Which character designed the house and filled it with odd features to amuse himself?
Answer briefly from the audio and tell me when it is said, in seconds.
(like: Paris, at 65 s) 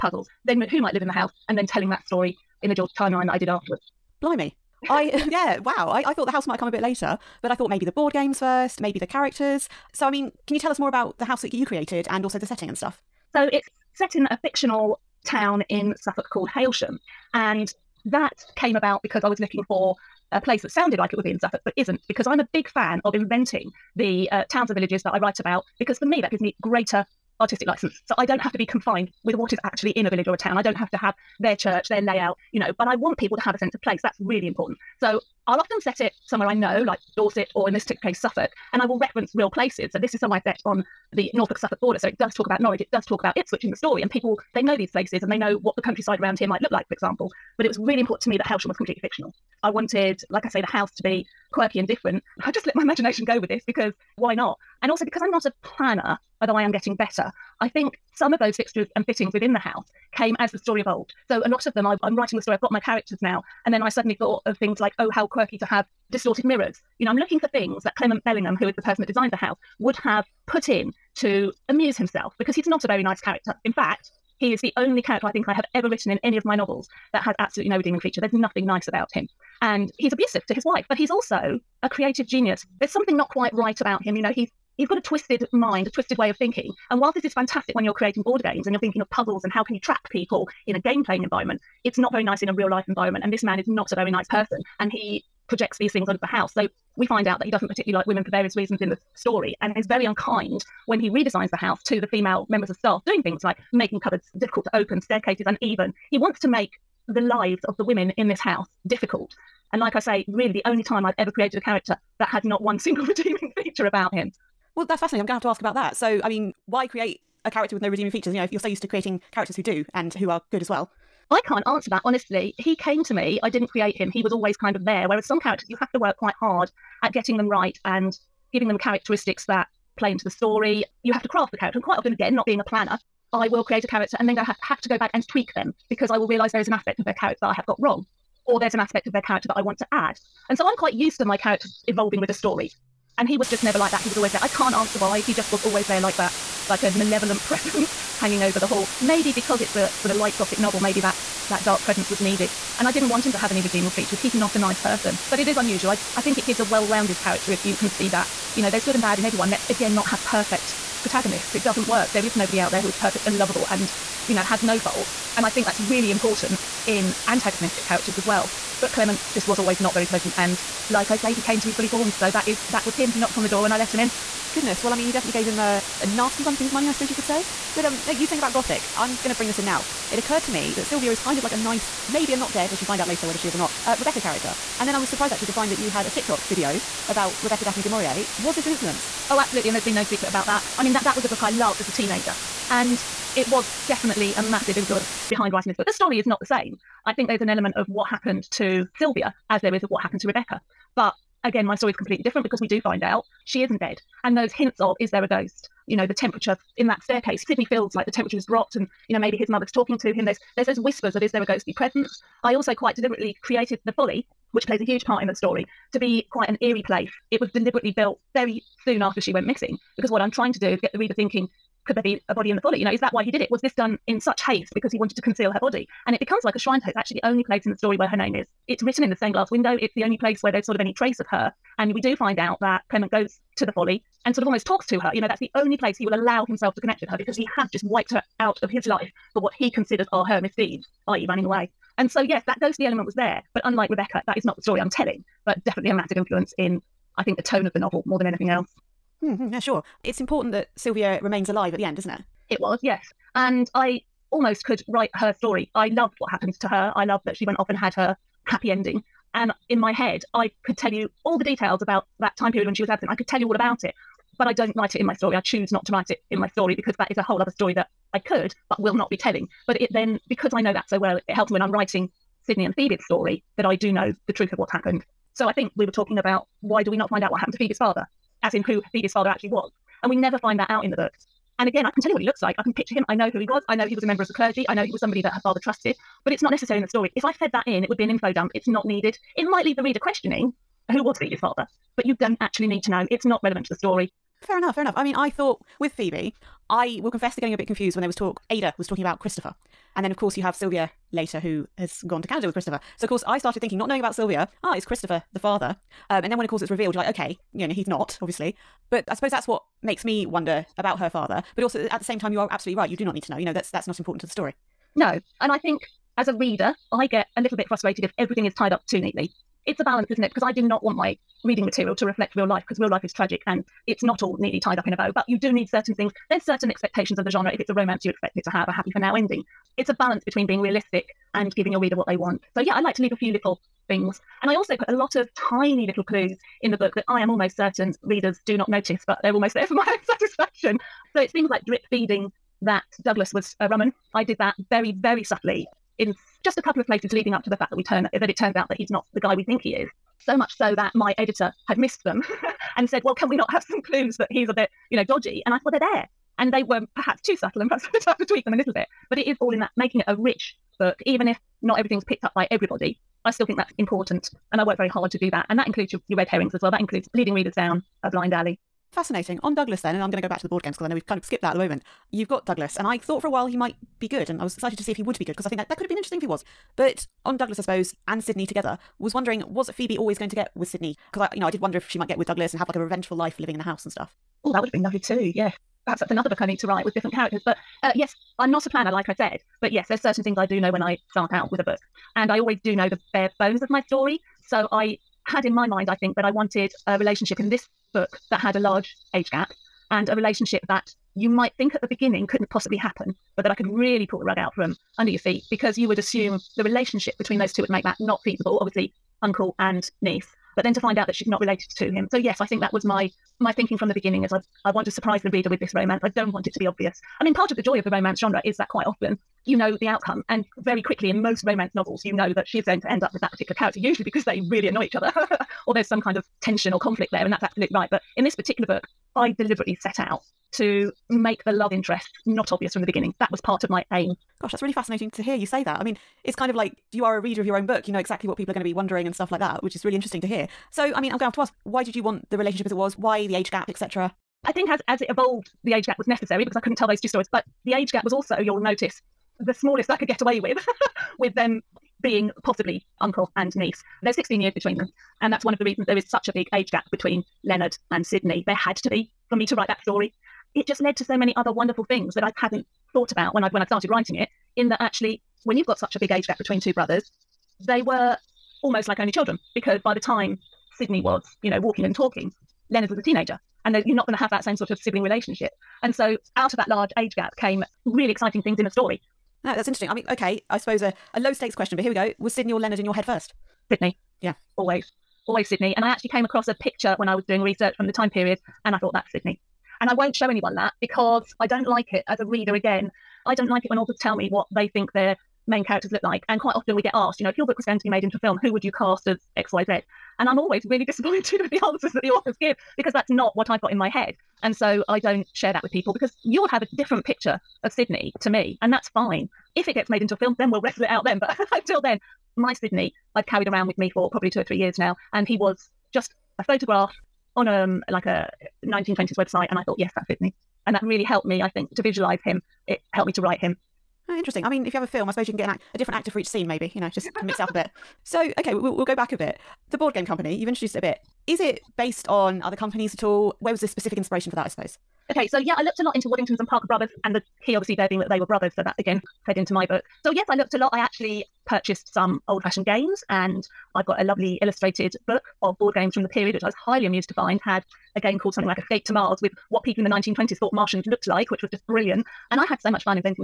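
Clement Bellingham, at 67 s.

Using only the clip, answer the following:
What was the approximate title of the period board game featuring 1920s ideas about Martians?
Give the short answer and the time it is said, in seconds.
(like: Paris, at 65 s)
Escape to Mars, at 548 s.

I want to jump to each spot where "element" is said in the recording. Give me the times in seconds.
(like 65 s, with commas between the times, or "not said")
197 s, 242 s.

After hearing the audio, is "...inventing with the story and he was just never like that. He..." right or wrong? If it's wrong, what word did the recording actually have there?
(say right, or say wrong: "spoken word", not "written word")
wrong: "evolving", not "inventing".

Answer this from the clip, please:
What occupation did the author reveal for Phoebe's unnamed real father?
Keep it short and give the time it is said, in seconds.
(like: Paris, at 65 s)
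clergy, at 284 s.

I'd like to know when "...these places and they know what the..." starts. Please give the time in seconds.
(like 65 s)
44 s.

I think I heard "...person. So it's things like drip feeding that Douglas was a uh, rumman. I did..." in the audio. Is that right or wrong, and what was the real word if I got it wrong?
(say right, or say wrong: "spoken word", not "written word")
wrong: "satisfaction", not "person".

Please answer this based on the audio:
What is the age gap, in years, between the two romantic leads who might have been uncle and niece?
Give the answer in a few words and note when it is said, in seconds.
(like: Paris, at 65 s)
16, at 454 s.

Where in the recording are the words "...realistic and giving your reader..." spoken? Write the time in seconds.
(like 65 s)
330 s.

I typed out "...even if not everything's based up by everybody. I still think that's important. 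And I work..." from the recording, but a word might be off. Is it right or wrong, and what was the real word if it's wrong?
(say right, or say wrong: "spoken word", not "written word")
wrong: "picked", not "based".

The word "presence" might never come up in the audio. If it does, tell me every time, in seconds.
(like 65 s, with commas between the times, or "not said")
147 s, 151 s, 211 s.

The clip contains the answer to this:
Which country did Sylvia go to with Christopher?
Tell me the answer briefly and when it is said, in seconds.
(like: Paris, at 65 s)
Canada, at 302 s.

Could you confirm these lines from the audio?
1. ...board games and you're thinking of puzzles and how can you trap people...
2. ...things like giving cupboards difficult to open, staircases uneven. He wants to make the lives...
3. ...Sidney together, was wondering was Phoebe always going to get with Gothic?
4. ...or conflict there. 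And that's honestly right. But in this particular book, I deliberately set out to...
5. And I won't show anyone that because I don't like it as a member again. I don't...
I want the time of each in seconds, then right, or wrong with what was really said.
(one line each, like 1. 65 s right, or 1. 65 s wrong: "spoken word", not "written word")
1. 88 s right
2. 103 s wrong: "making", not "giving"
3. 378 s wrong: "Sidney", not "Gothic"
4. 426 s wrong: "absolutely", not "honestly"
5. 489 s wrong: "reader", not "member".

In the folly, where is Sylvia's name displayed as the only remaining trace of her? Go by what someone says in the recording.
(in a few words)
stained glass window.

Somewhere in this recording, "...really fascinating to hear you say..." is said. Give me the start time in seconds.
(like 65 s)
434 s.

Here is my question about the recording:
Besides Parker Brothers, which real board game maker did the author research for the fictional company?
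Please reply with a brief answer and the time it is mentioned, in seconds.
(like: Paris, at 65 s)
Waddingtons, at 536 s.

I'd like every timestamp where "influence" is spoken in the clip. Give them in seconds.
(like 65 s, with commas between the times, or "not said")
188 s, 194 s, 246 s.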